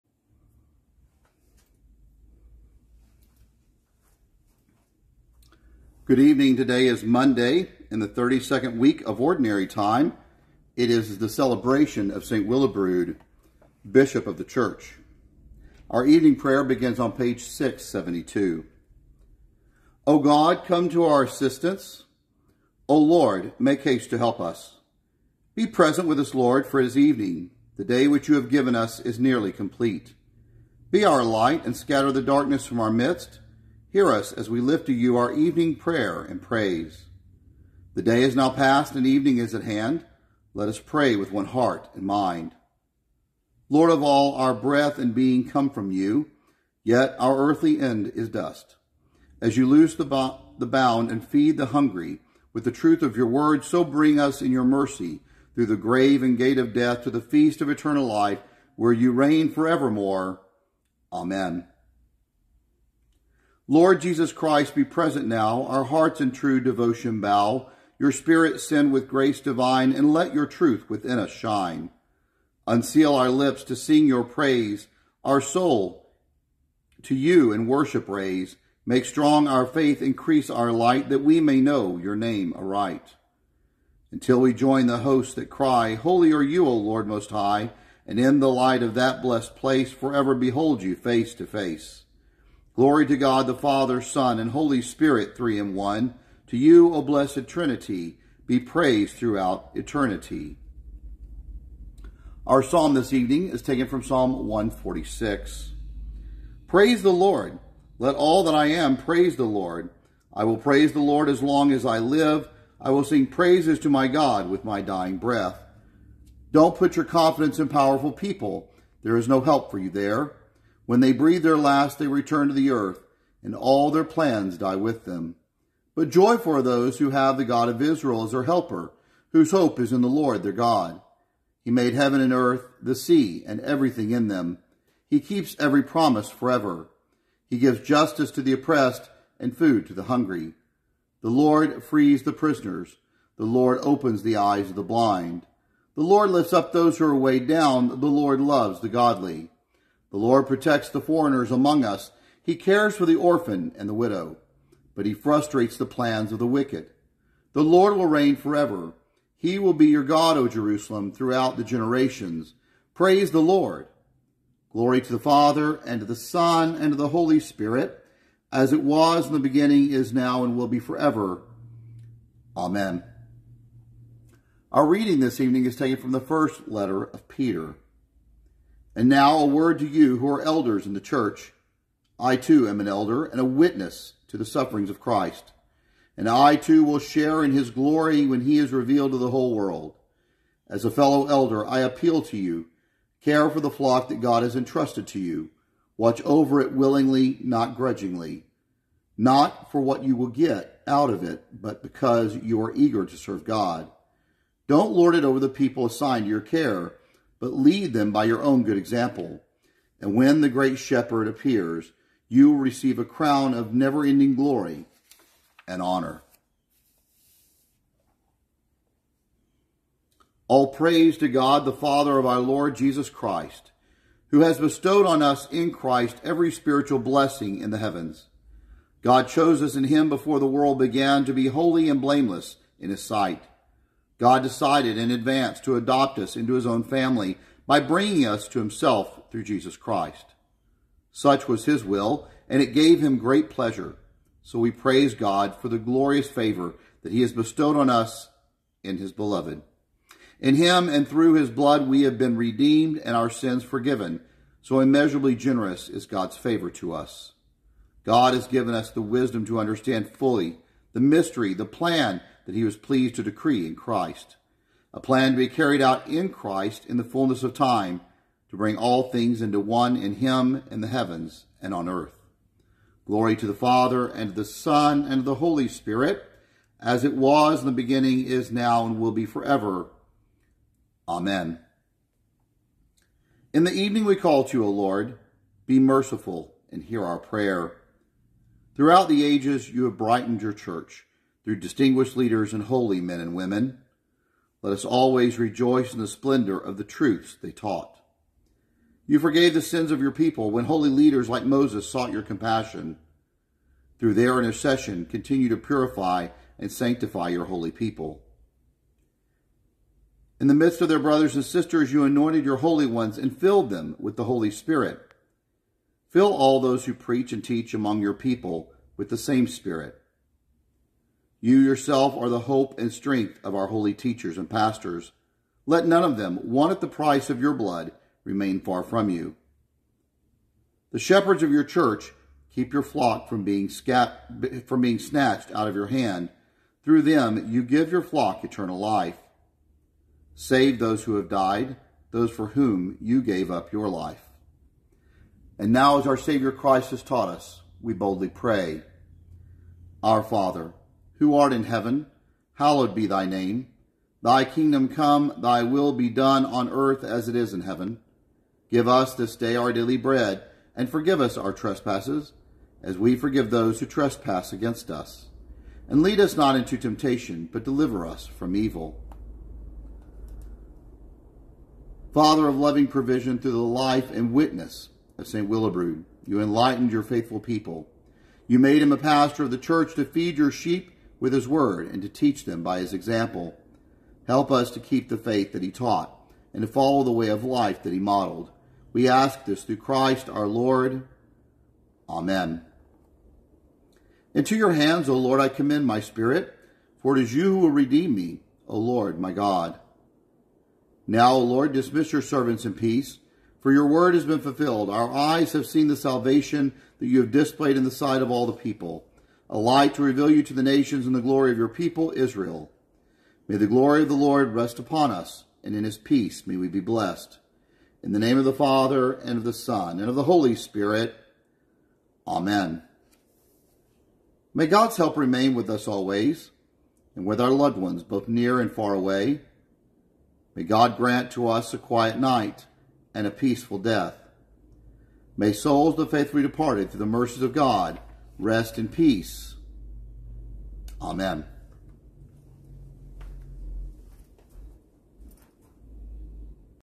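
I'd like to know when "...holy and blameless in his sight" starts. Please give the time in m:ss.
3:51.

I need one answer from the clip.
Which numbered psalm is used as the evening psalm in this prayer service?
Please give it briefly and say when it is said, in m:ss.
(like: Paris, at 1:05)
Psalm 146, at 1:44.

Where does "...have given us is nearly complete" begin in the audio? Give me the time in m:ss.
0:28.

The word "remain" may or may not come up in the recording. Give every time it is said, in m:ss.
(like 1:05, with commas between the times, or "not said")
5:28, 7:05.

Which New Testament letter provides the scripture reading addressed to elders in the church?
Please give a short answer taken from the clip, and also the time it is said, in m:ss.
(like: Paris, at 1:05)
first letter of Peter, at 2:56.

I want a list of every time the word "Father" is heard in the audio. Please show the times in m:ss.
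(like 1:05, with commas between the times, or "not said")
1:33, 2:45, 3:41, 4:33, 5:50, 6:12, 6:58.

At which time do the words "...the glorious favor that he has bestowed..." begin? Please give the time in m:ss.
4:05.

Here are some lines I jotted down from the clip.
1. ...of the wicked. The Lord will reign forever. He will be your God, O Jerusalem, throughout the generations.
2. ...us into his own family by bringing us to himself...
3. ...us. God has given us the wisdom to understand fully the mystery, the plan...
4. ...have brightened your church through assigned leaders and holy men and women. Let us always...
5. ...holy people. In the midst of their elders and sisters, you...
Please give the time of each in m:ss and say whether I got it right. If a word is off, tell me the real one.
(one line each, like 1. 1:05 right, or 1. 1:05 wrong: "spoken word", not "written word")
1. 2:36 right
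2. 3:56 right
3. 4:16 right
4. 4:49 wrong: "distinguished", not "assigned"
5. 5:07 wrong: "brothers", not "elders".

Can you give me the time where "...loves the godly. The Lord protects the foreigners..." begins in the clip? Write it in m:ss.
2:28.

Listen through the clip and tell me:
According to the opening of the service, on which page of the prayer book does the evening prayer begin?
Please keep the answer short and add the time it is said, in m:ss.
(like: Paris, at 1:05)
672, at 0:17.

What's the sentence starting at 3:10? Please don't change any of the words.
As a fellow elder, I appeal to you care for the flock that God has entrusted to you.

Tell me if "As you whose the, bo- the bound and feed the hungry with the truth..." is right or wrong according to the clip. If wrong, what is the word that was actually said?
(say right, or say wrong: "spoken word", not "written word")
wrong: "loose", not "whose".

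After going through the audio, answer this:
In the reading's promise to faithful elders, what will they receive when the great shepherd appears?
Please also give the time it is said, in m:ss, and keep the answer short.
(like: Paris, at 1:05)
a crown, at 3:32.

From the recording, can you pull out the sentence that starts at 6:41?
Now, O Lord, dismiss your servants in peace, for your word has been fulfilled.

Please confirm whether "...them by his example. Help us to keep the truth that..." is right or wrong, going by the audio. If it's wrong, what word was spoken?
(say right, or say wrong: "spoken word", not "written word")
wrong: "faith", not "truth".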